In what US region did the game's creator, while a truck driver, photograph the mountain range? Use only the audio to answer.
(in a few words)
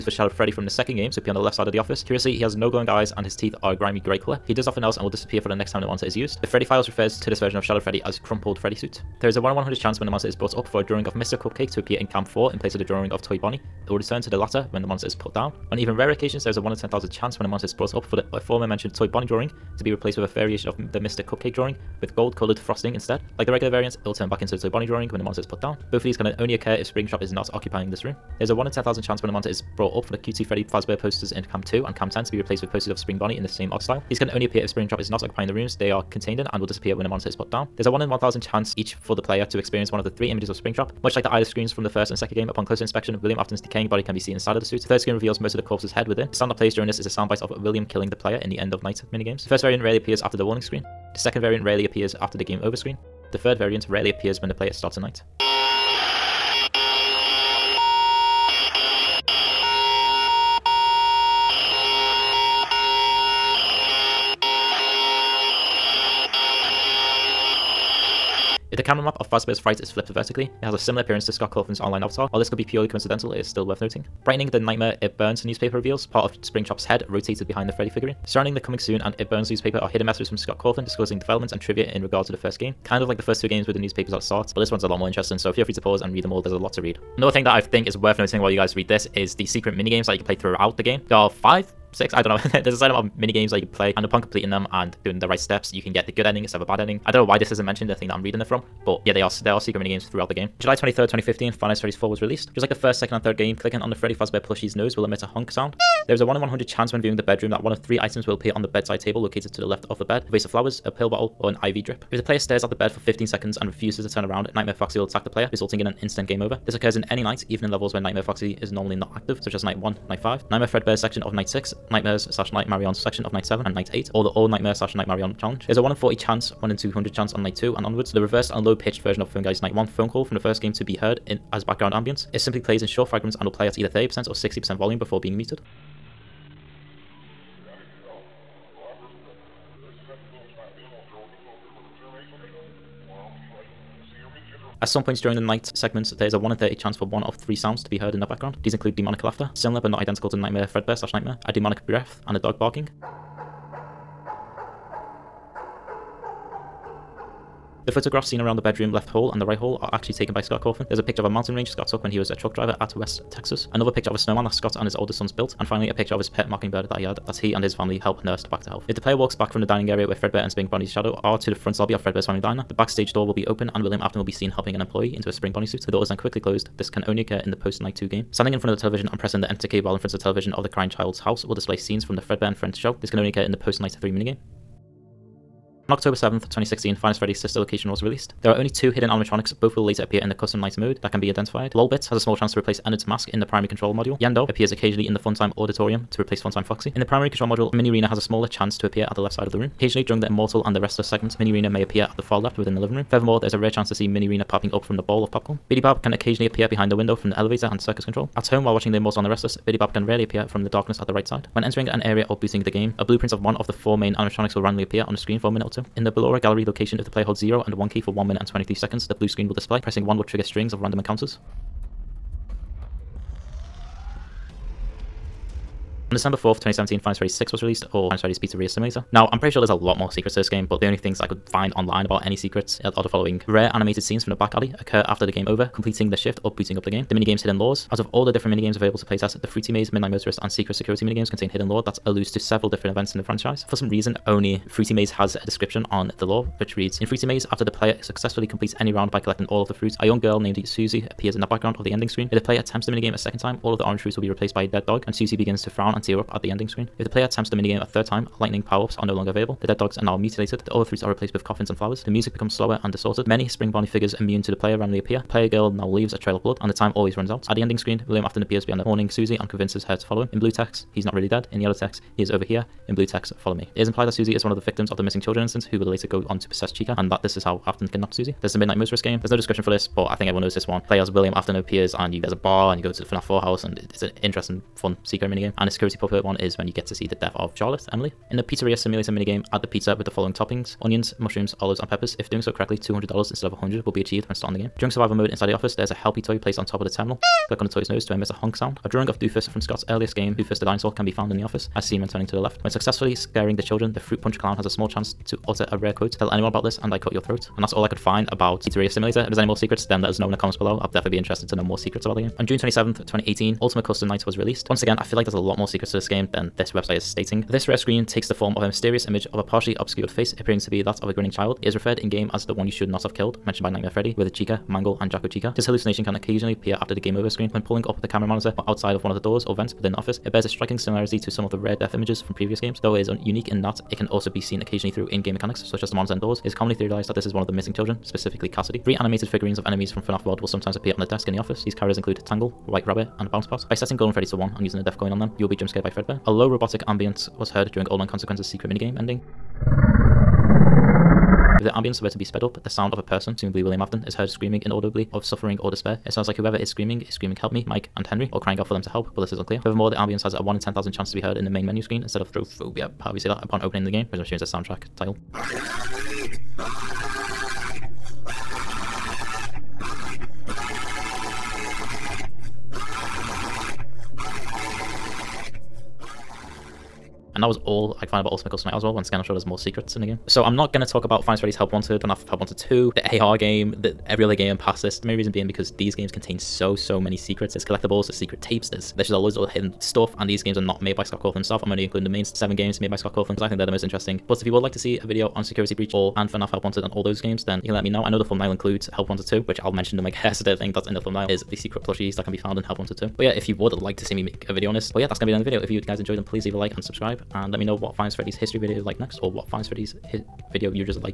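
West Texas.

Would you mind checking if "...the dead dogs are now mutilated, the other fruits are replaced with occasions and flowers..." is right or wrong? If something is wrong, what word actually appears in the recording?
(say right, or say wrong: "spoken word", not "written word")
wrong: "coffins", not "occasions".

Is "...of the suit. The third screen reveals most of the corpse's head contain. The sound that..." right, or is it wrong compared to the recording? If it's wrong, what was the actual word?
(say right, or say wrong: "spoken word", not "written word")
wrong: "within", not "contain".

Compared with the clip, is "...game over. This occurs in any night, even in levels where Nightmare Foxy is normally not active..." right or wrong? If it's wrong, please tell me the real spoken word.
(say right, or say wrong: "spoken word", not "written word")
right.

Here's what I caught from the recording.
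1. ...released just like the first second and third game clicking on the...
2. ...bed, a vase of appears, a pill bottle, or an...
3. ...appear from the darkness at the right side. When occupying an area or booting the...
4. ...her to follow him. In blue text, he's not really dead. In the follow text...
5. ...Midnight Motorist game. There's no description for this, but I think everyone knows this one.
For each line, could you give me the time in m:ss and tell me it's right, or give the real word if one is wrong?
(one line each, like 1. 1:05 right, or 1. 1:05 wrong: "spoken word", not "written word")
1. 1:42 right
2. 1:50 wrong: "flowers", not "appears"
3. 3:30 wrong: "entering", not "occupying"
4. 4:29 wrong: "yellow", not "follow"
5. 4:38 right.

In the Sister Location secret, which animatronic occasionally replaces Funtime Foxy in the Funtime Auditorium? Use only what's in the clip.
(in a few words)
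Yenndo.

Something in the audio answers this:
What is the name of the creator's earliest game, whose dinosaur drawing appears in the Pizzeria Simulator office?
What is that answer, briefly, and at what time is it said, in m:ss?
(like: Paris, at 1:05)
Doofus the Dinosaur, at 5:00.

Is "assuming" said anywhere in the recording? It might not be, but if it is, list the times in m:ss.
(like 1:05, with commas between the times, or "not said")
6:04.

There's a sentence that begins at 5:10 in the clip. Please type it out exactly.
I'll definitely be interested to know more secrets about the game.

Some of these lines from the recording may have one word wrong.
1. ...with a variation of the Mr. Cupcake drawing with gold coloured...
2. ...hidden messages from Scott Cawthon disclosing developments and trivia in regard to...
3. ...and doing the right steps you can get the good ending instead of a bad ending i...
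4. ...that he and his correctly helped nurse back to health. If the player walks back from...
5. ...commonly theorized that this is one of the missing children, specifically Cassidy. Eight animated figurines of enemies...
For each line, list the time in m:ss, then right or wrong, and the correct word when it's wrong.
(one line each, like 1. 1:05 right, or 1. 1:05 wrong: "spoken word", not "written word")
1. 0:20 right
2. 1:19 right
3. 1:34 right
4. 2:47 wrong: "family", not "correctly"
5. 5:36 wrong: "Three", not "Eight".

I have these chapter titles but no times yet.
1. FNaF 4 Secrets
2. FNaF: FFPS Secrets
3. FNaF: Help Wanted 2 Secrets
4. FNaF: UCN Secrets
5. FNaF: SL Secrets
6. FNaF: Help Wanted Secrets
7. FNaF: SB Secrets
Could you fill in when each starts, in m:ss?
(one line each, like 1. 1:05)
1. 1:40
2. 3:46
3. 6:37
4. 5:12
5. 3:06
6. 6:20
7. 6:26.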